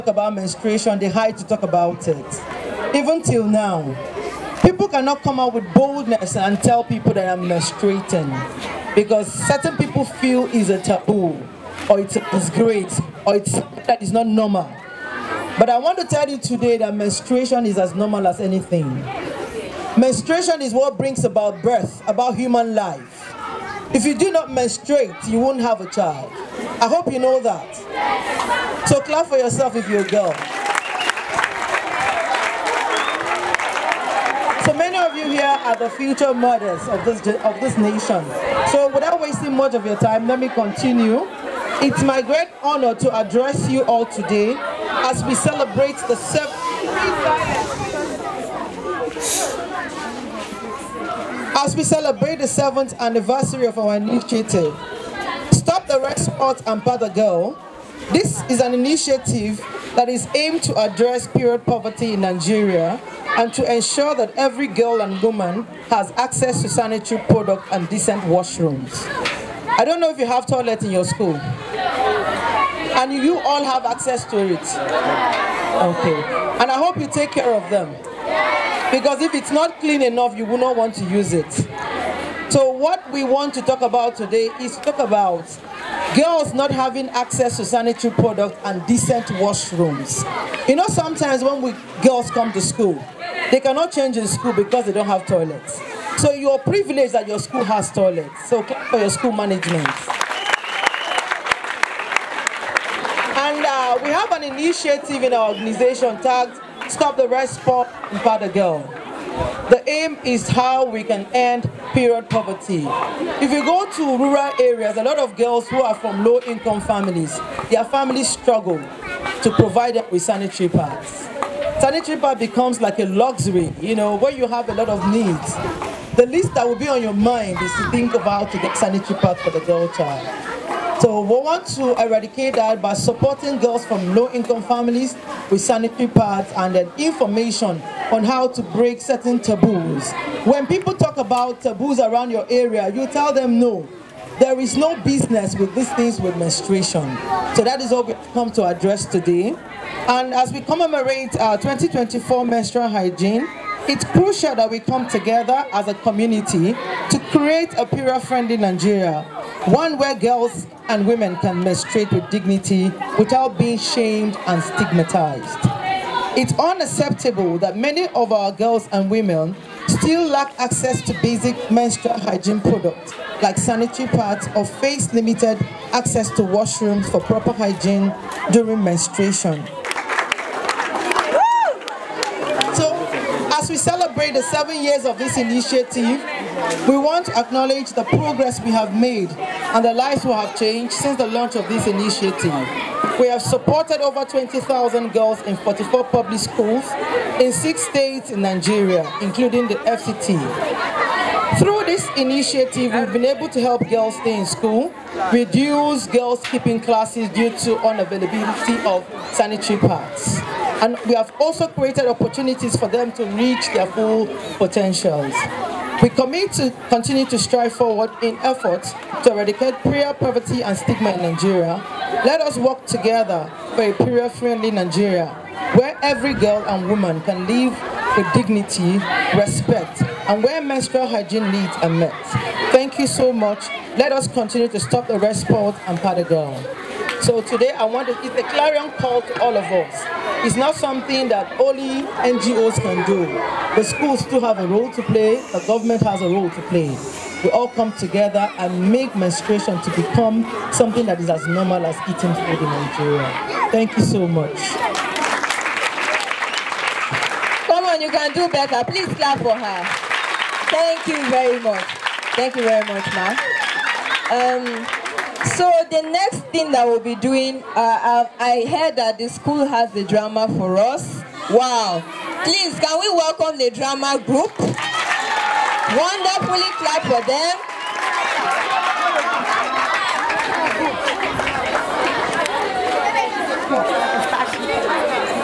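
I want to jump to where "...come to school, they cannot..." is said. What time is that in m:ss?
1:32.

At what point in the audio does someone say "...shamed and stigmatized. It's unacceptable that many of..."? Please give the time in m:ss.
2:43.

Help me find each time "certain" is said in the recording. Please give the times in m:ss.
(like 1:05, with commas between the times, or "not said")
0:09, 2:19.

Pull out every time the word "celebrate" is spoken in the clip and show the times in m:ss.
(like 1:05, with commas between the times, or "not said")
0:45, 0:51, 3:03.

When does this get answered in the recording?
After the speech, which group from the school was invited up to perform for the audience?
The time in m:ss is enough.
4:33.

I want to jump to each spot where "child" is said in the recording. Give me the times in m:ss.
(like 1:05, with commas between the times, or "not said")
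0:25, 2:09.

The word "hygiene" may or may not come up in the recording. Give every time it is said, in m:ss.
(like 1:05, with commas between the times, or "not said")
2:32, 2:52, 2:57, 3:51.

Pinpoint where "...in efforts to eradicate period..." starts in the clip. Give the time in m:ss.
3:38.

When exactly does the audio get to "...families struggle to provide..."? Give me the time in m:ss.
1:57.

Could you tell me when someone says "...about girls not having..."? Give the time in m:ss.
1:24.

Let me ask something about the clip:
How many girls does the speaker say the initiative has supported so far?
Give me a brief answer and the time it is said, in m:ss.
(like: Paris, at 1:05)
20,000, at 3:14.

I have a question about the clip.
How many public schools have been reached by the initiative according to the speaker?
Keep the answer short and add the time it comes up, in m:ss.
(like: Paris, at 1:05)
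44, at 3:15.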